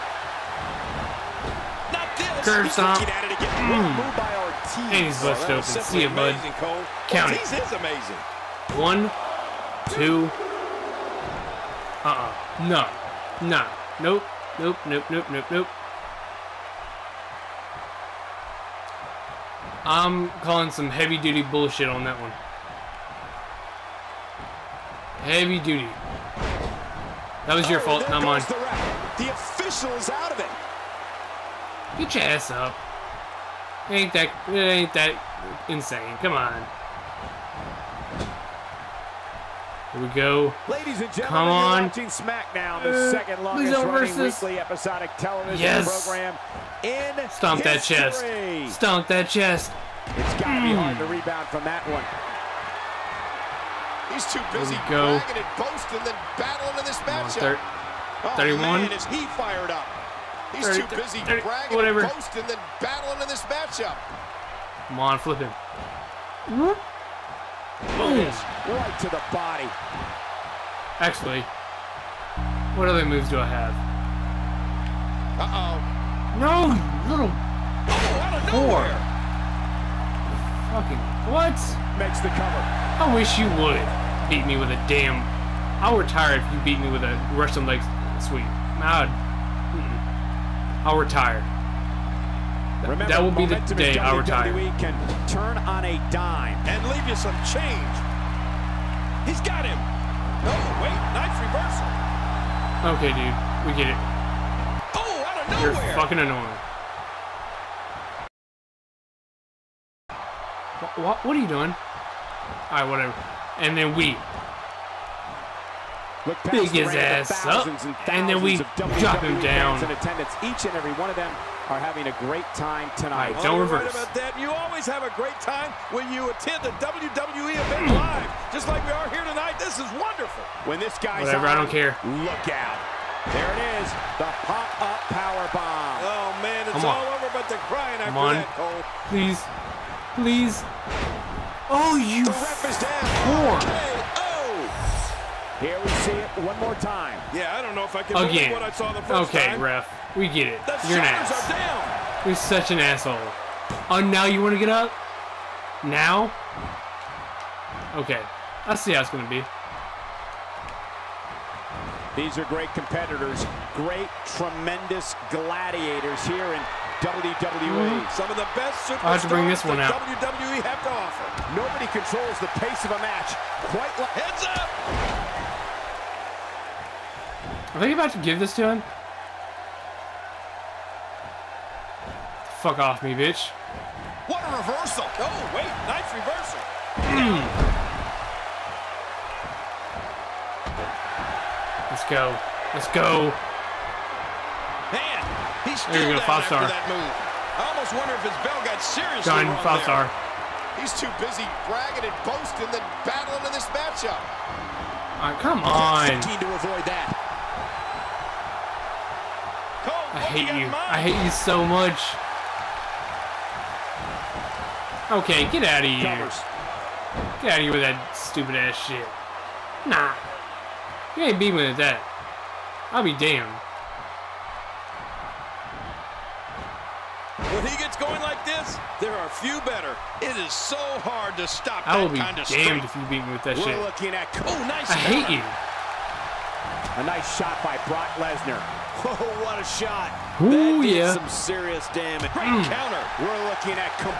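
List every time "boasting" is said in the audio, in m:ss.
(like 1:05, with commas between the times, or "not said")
0:55, 1:02, 3:22.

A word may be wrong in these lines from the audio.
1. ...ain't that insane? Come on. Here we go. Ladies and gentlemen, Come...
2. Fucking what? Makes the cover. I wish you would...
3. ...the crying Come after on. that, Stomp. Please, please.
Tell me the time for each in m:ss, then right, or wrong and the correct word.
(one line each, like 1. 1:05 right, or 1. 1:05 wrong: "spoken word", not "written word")
1. 0:34 right
2. 1:20 right
3. 2:17 wrong: "Cole", not "Stomp".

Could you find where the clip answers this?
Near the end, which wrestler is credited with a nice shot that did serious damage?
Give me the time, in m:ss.
3:57.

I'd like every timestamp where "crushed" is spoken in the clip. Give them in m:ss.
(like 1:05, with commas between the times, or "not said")
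not said.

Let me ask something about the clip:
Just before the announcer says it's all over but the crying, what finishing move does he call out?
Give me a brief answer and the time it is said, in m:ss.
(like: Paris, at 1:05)
Pop-up power bomb, at 2:14.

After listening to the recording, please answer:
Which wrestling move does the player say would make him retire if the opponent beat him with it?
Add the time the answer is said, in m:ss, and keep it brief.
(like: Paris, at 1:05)
Russian leg sweep, at 1:27.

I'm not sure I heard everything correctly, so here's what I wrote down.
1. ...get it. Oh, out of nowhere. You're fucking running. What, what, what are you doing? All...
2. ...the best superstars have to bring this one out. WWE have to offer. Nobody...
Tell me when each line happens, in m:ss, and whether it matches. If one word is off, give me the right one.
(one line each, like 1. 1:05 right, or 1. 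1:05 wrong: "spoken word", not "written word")
1. 1:43 wrong: "annoying", not "running"
2. 2:48 right.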